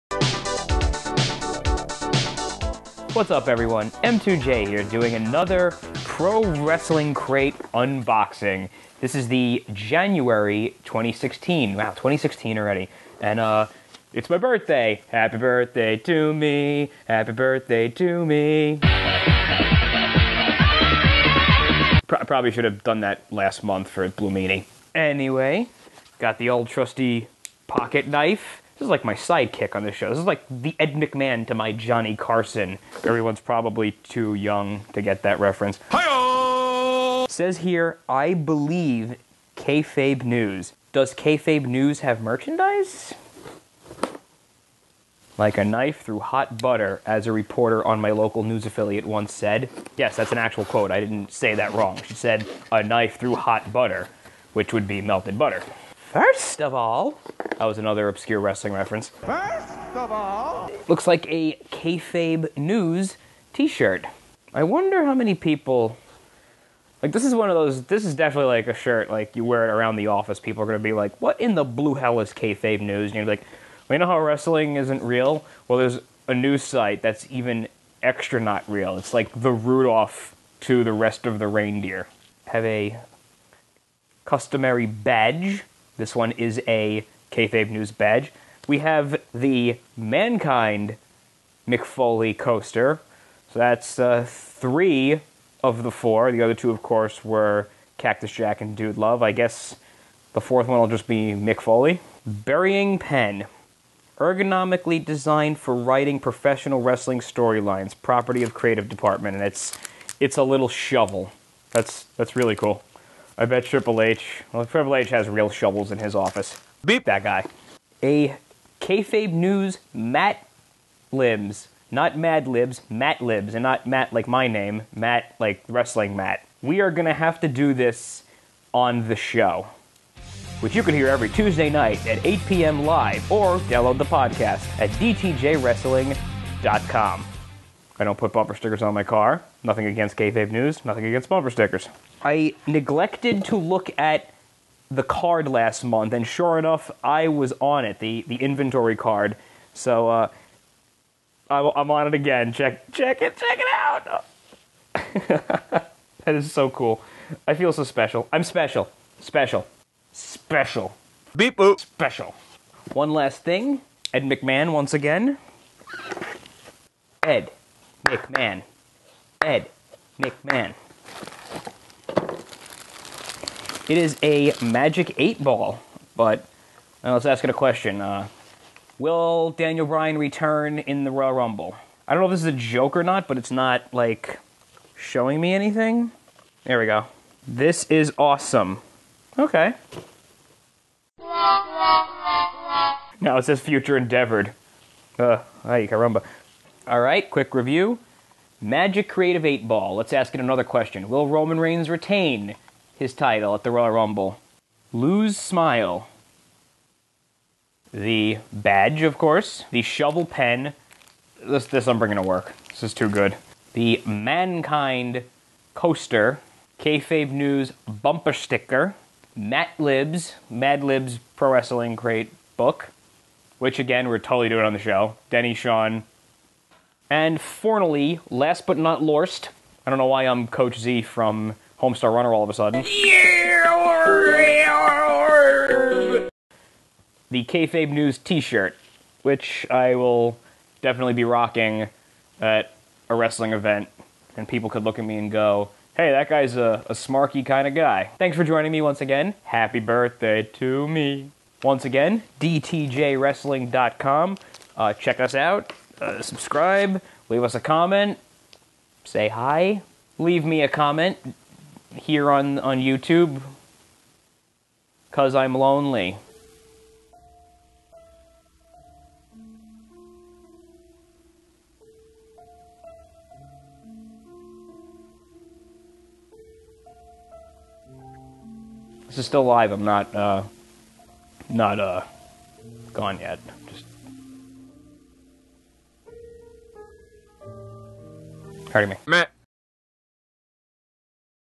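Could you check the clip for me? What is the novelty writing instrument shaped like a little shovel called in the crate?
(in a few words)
Burying Pen.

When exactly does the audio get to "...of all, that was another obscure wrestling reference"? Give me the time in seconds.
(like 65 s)
56 s.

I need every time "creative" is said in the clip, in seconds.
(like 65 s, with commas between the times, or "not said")
108 s, 199 s.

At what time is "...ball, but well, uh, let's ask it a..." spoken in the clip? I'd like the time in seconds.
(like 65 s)
175 s.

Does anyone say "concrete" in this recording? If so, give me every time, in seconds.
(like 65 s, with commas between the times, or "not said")
not said.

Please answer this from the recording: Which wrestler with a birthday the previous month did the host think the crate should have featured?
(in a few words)
Blue Meanie.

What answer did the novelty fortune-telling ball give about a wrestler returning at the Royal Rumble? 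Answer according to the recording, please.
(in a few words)
Future endeavored.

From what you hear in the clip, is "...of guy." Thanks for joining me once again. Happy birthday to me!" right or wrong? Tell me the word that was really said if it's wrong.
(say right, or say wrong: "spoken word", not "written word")
right.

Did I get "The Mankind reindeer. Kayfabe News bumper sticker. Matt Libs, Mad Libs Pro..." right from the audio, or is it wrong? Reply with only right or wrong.
wrong.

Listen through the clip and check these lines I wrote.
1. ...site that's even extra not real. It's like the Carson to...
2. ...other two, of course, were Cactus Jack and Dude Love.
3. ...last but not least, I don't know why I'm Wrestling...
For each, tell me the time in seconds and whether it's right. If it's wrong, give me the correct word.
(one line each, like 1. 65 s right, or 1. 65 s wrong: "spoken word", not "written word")
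1. 76 s wrong: "Rudolph", not "Carson"
2. 96 s right
3. 228 s wrong: "Coach", not "Wrestling".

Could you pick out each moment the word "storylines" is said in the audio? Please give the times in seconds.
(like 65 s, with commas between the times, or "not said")
107 s.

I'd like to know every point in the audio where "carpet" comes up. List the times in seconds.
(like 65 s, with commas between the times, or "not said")
not said.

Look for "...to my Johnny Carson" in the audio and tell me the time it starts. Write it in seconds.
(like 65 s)
31 s.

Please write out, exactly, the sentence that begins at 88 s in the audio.
We have the Mankind Mick Foley coaster.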